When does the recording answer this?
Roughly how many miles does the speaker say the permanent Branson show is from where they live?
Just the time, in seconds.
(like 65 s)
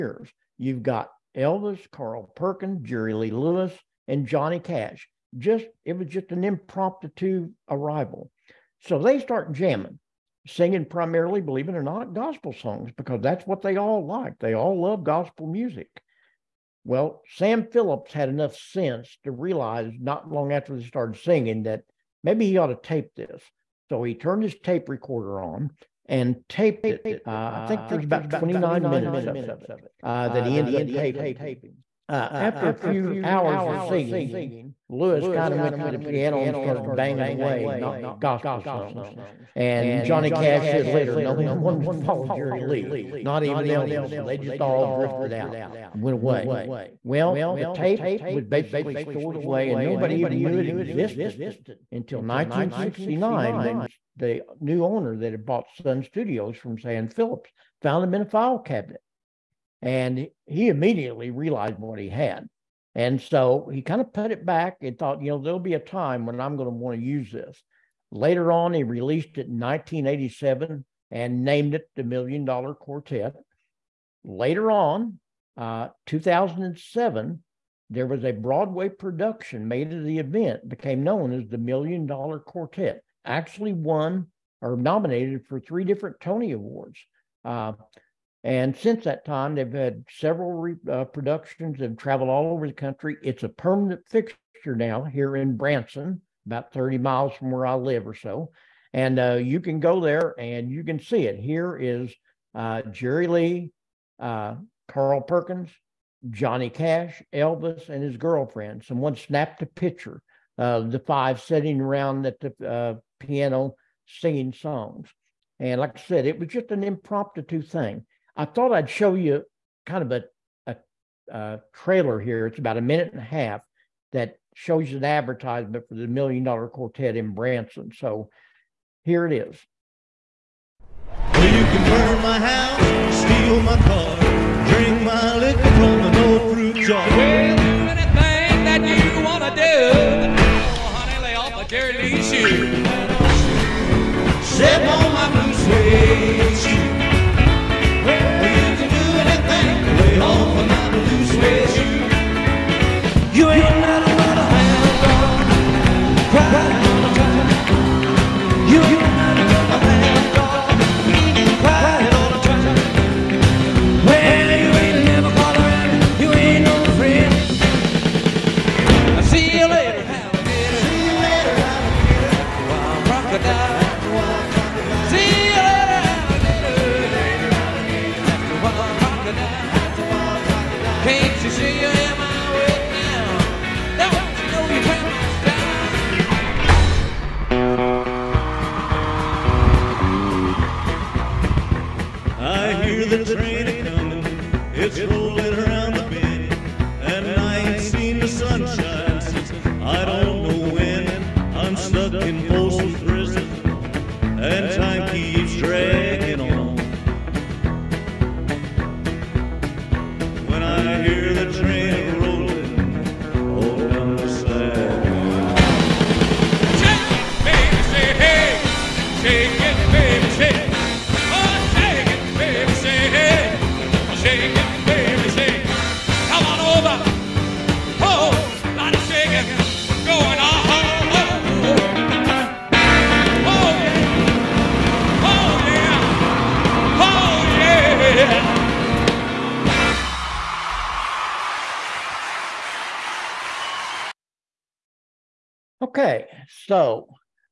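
96 s.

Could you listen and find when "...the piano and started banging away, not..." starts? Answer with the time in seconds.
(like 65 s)
35 s.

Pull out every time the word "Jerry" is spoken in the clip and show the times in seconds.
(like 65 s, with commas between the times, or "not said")
2 s, 42 s, 102 s.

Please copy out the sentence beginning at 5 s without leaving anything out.
Just it was just an impromptu arrival.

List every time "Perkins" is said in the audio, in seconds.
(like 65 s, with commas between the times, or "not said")
2 s, 105 s.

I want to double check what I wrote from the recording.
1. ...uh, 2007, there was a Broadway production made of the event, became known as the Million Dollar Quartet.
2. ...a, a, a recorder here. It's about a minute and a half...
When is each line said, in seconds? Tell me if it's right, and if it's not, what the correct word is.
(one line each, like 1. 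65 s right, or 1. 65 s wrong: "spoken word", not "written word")
1. 75 s right
2. 120 s wrong: "trailer", not "recorder".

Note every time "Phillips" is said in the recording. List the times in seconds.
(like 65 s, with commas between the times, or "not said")
17 s, 57 s.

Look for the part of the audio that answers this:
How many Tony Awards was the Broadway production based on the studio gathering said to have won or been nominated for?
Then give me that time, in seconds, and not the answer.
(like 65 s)
85 s.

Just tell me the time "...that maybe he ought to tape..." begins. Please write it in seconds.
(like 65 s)
21 s.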